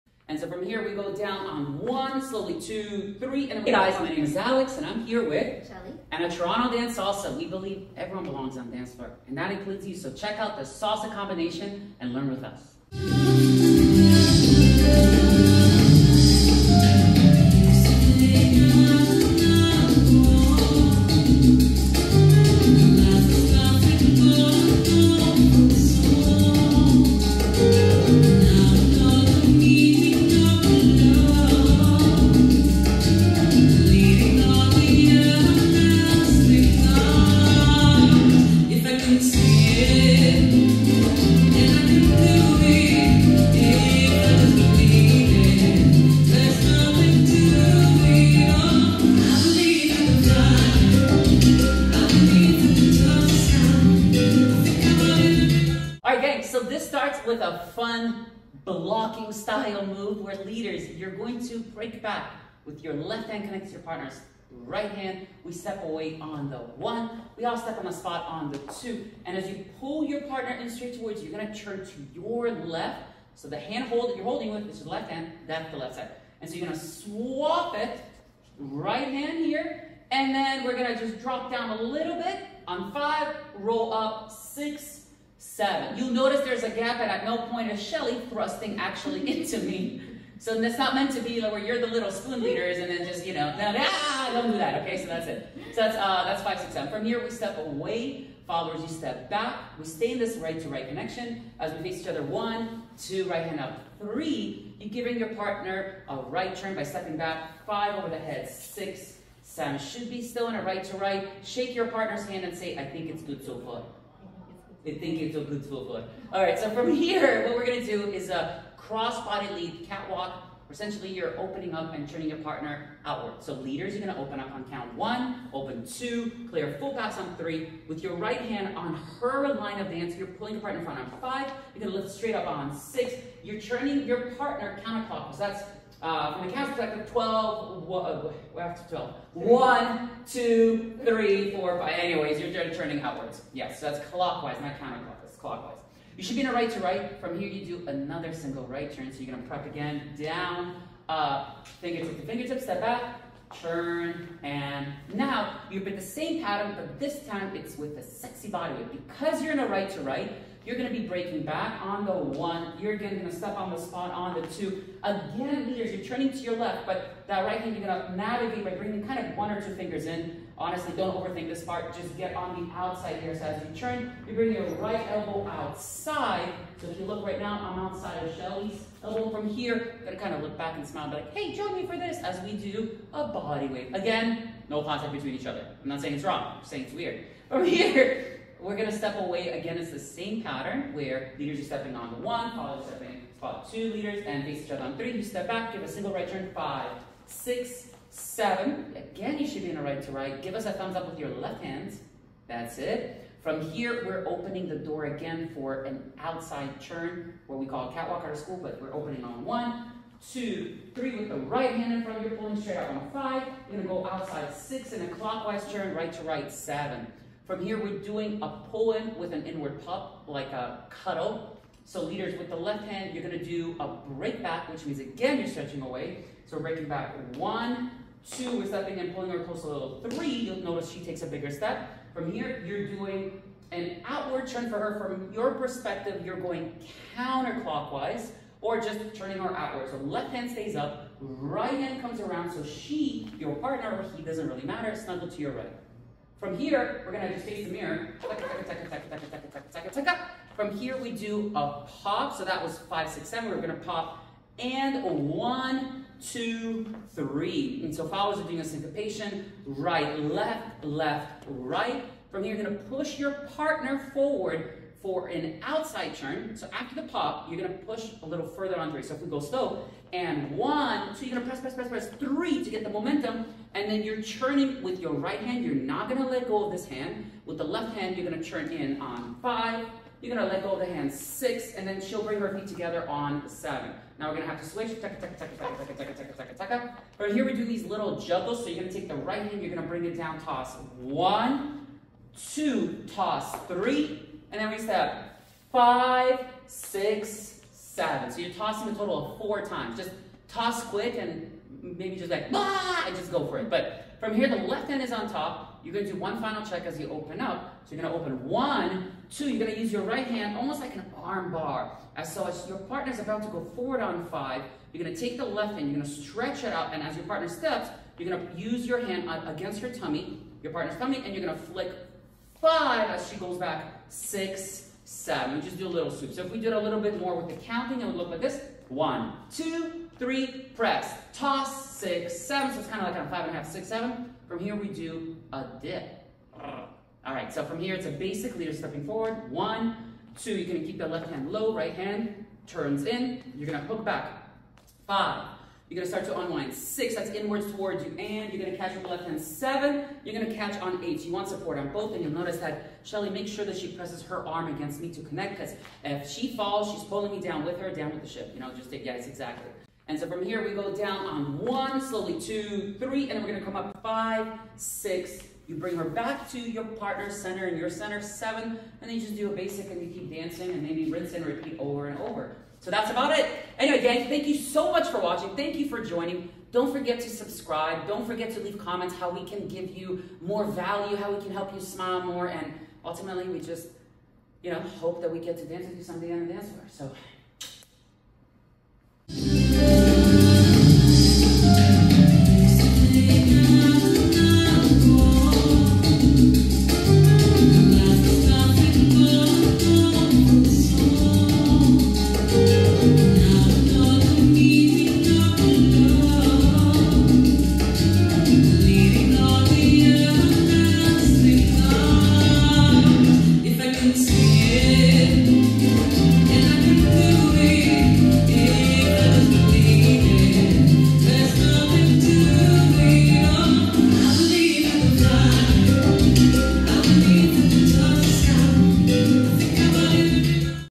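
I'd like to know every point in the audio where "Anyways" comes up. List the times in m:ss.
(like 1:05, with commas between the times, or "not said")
2:21, 6:13.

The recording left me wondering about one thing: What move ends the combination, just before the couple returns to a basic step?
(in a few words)
a dip.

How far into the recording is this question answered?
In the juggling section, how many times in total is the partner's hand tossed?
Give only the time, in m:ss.
4:59.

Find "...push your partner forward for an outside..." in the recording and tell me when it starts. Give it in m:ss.
4:22.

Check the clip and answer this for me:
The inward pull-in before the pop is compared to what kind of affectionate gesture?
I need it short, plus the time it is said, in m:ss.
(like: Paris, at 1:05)
a cuddle, at 3:40.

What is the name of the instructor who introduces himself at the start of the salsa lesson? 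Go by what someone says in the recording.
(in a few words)
Aleks.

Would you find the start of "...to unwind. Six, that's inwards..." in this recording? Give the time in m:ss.
5:46.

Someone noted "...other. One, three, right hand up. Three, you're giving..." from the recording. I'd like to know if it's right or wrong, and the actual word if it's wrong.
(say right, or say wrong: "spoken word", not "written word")
wrong: "two", not "three".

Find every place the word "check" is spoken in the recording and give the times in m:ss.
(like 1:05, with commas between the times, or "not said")
0:10, 5:06.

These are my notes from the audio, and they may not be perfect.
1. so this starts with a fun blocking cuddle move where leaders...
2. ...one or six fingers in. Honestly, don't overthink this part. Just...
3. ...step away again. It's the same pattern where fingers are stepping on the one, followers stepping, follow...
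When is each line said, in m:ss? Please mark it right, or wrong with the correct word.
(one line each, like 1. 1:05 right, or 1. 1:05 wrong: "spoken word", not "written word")
1. 0:56 wrong: "style", not "cuddle"
2. 2:49 wrong: "two", not "six"
3. 3:08 wrong: "leaders", not "fingers".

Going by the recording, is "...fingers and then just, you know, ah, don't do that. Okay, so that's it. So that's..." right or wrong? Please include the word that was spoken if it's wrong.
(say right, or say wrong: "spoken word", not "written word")
wrong: "leaders", not "fingers".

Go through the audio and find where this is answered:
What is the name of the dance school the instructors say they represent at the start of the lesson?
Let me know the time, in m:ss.
0:06.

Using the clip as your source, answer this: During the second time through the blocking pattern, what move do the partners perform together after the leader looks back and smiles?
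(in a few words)
body wave.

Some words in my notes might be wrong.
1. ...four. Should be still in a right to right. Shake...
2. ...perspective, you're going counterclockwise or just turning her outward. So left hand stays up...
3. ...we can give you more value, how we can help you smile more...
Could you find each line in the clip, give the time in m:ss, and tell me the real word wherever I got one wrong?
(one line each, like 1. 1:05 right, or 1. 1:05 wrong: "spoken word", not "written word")
1. 1:49 wrong: "seven", not "four"
2. 3:55 right
3. 6:19 right.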